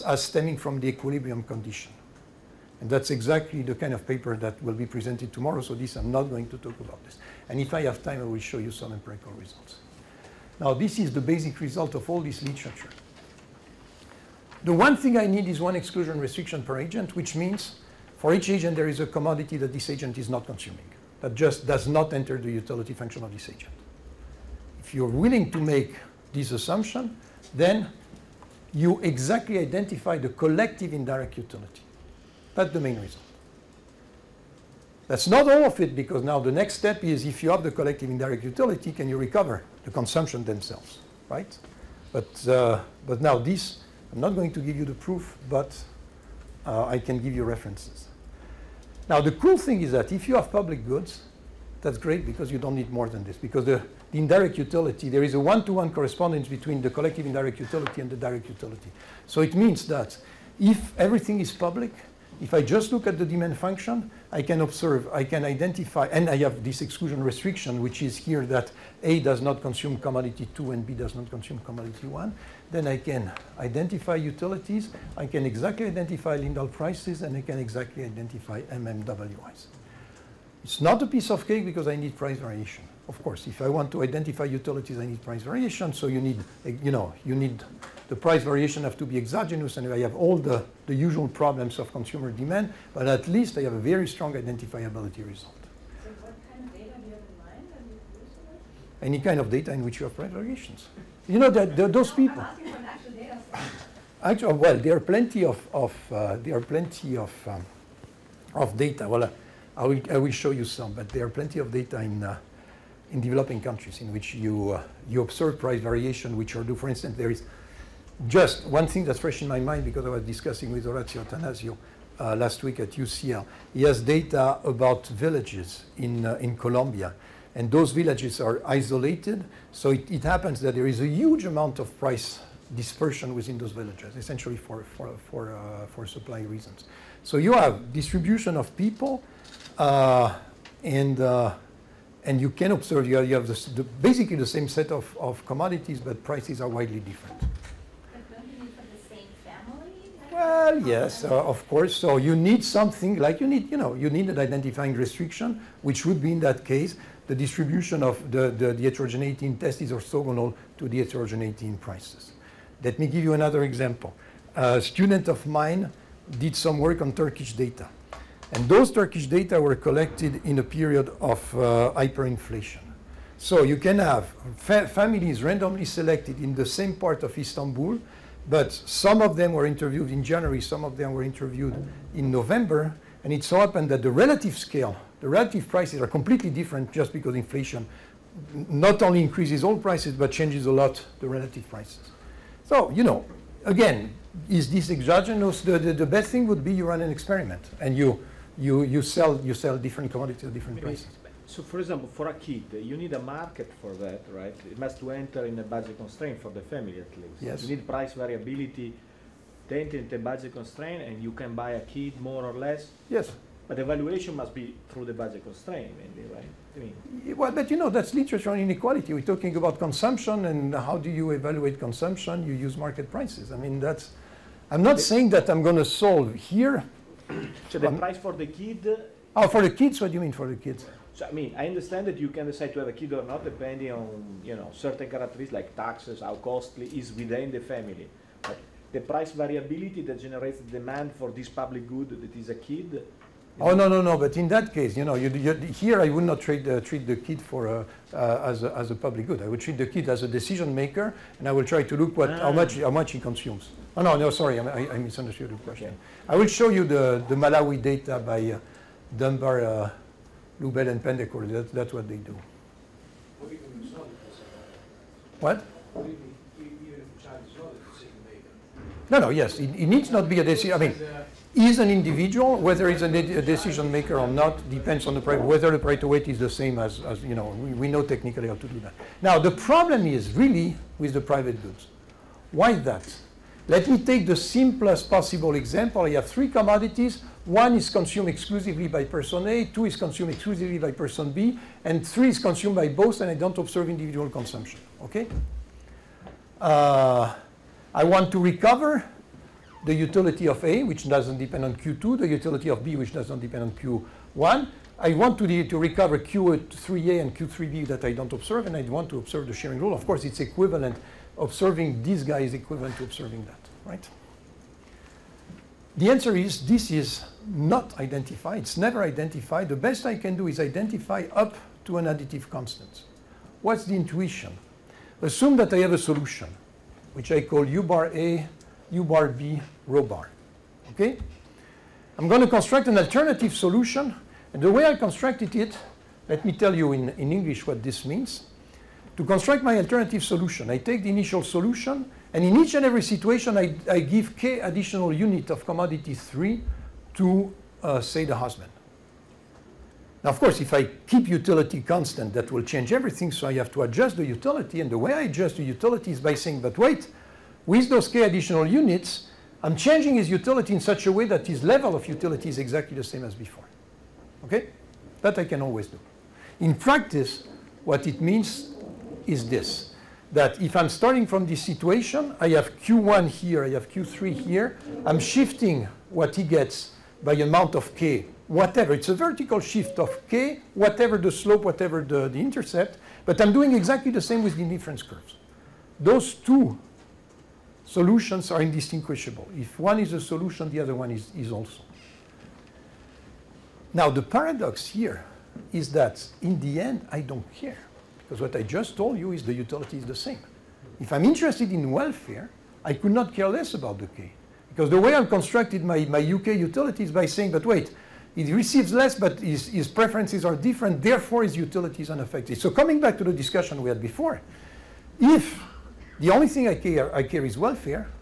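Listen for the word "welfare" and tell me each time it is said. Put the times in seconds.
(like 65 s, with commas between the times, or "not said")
401 s, 417 s.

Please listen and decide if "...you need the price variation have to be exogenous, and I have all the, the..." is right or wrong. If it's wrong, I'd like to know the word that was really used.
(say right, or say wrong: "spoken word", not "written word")
right.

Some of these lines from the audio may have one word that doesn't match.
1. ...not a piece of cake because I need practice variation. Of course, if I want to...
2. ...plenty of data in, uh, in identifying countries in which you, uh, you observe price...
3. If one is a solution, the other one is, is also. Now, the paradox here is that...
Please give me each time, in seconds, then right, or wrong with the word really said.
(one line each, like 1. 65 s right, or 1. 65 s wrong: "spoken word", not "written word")
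1. 80 s wrong: "price", not "practice"
2. 111 s wrong: "developing", not "identifying"
3. 389 s right.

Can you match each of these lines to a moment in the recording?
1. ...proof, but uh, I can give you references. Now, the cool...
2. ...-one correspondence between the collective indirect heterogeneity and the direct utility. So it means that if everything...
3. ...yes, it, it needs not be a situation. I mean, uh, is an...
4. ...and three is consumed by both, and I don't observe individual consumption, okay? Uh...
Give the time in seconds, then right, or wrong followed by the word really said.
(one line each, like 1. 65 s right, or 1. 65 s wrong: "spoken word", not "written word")
1. 44 s right
2. 55 s wrong: "utility", not "heterogeneity"
3. 269 s wrong: "decision", not "situation"
4. 291 s right.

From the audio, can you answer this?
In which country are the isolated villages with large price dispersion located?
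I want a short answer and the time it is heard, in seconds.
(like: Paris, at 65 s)
Colombia, at 126 s.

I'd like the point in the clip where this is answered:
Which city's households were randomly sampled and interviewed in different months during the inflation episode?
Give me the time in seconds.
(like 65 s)
177 s.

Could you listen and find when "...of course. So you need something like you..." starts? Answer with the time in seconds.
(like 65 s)
151 s.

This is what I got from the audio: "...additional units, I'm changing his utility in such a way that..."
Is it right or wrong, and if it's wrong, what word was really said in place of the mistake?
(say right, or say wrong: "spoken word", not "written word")
right.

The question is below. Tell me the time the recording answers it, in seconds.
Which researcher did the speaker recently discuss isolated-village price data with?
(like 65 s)
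120 s.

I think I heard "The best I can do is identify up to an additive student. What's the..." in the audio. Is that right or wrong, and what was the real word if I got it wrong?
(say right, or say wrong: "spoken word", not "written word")
wrong: "constant", not "student".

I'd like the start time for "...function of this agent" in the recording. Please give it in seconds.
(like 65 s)
22 s.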